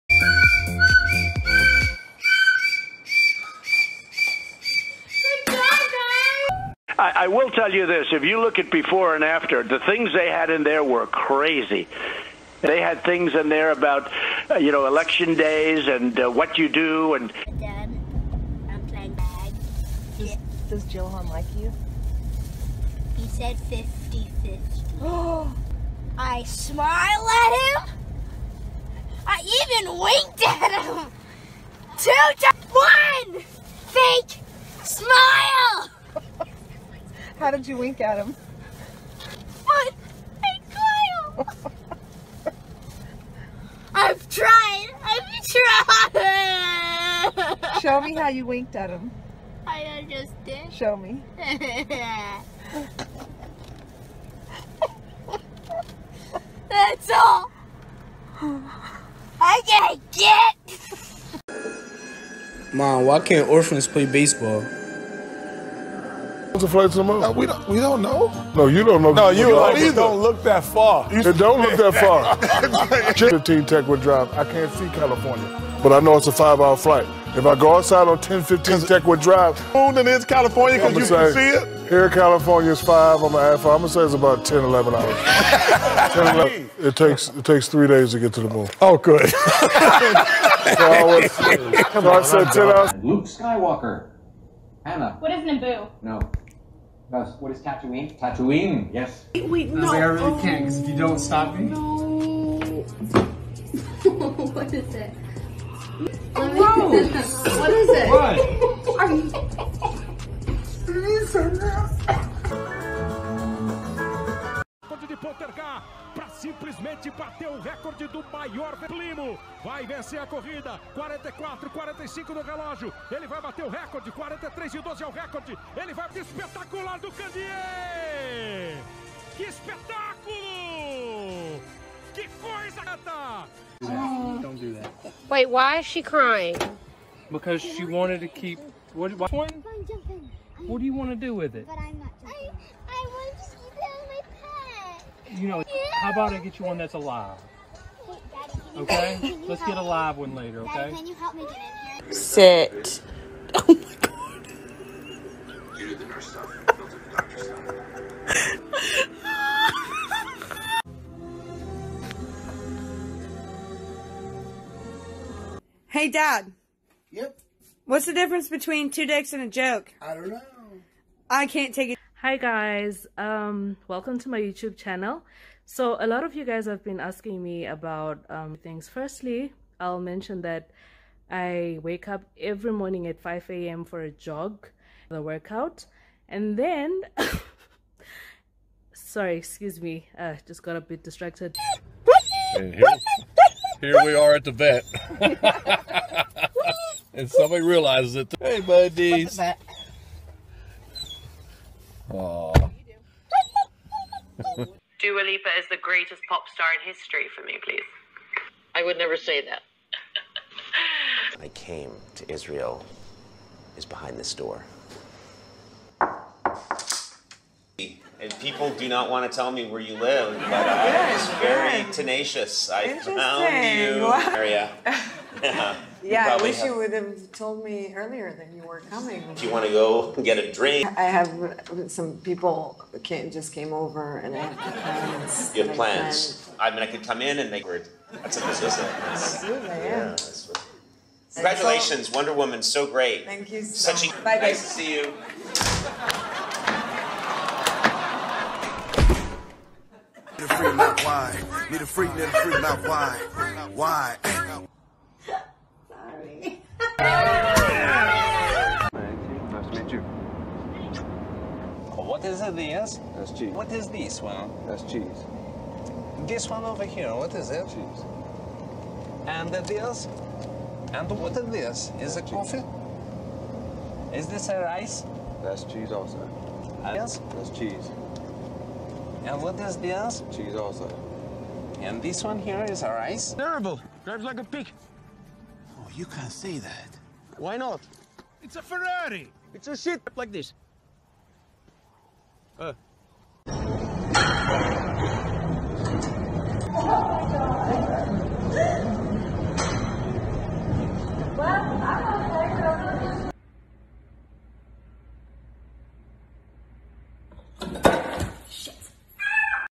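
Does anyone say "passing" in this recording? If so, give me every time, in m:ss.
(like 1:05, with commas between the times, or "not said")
not said.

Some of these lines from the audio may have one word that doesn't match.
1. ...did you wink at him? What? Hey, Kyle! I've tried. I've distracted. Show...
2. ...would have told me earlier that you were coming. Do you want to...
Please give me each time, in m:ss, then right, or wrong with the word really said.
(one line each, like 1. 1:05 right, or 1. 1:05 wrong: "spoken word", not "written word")
1. 0:37 wrong: "tried", not "distracted"
2. 3:46 right.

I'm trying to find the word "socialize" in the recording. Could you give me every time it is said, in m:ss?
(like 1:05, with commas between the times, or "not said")
not said.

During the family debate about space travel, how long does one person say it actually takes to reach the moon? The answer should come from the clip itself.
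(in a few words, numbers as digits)
3 days.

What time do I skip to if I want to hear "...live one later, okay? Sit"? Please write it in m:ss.
2:29.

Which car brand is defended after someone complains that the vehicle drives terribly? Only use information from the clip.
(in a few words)
Ferrari.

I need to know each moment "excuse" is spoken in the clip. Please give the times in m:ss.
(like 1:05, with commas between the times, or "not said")
3:09.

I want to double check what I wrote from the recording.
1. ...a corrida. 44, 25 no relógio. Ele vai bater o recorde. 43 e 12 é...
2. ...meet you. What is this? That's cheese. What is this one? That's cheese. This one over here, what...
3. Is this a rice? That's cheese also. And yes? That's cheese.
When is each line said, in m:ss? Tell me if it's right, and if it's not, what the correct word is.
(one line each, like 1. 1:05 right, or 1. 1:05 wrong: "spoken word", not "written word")
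1. 2:00 wrong: "45", not "25"
2. 4:19 right
3. 4:34 right.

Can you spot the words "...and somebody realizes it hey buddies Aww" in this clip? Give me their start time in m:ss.
3:17.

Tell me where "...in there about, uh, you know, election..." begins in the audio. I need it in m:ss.
0:13.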